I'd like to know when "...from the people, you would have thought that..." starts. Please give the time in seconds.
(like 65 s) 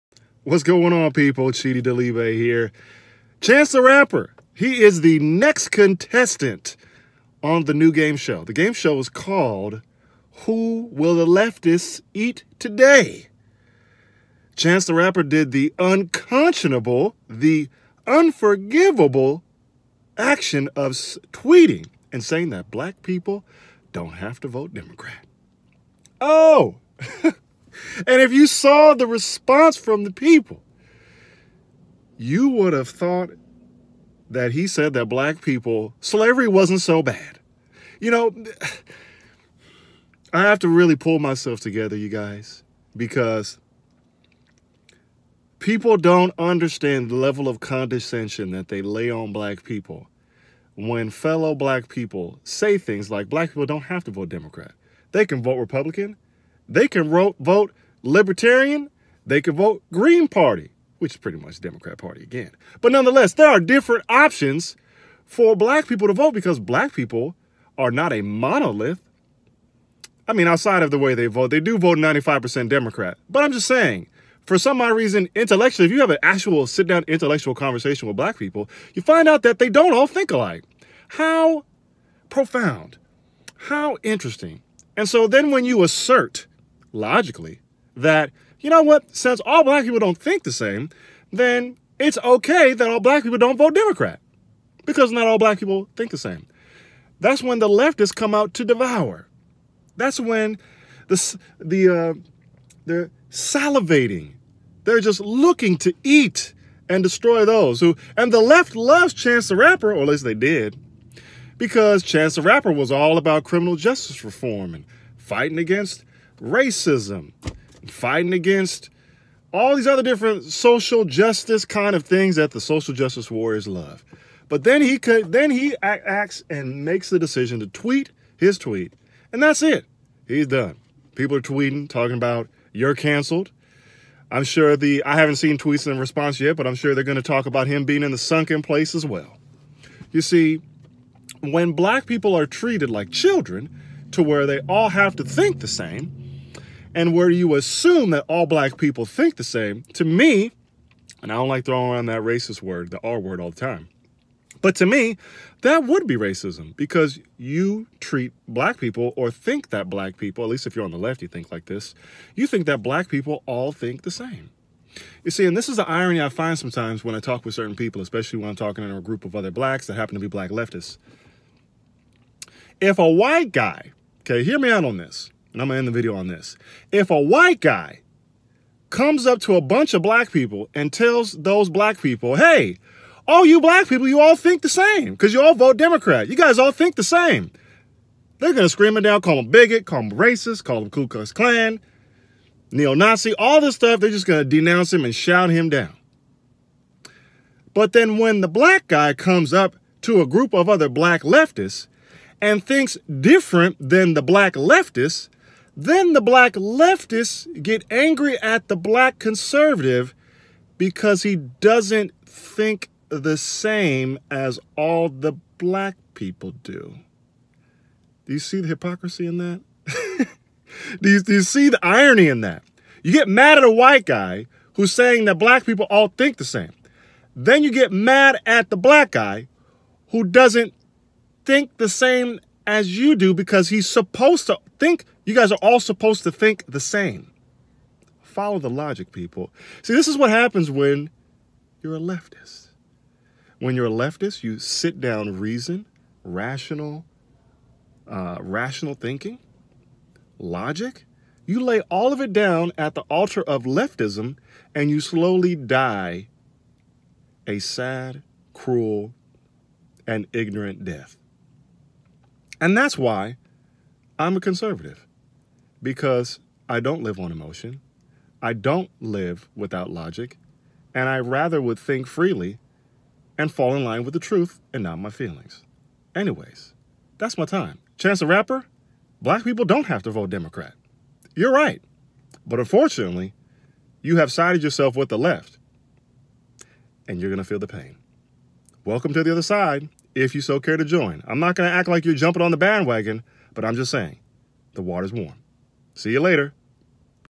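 29 s.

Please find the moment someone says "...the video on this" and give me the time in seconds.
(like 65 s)
175 s.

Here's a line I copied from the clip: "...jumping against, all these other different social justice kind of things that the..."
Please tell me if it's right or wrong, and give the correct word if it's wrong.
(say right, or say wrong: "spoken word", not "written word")
wrong: "fighting", not "jumping".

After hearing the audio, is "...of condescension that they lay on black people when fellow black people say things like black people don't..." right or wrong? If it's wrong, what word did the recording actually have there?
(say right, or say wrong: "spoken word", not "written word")
right.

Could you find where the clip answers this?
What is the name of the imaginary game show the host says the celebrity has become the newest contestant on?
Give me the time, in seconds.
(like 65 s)
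10 s.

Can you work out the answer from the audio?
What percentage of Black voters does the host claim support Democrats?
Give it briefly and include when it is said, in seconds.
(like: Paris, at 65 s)
95%, at 71 s.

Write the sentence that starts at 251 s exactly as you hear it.
You lay all of it down at the altar of leftism and you slowly die a sad, cruel, and ignorant death.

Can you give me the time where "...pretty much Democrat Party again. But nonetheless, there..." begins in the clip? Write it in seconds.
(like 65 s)
61 s.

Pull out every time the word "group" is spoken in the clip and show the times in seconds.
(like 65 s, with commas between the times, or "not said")
169 s, 200 s.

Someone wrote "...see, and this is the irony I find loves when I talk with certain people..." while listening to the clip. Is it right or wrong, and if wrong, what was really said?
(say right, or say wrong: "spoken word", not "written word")
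wrong: "sometimes", not "loves".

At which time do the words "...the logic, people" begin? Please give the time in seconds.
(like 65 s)
238 s.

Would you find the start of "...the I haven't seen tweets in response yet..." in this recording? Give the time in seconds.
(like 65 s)
134 s.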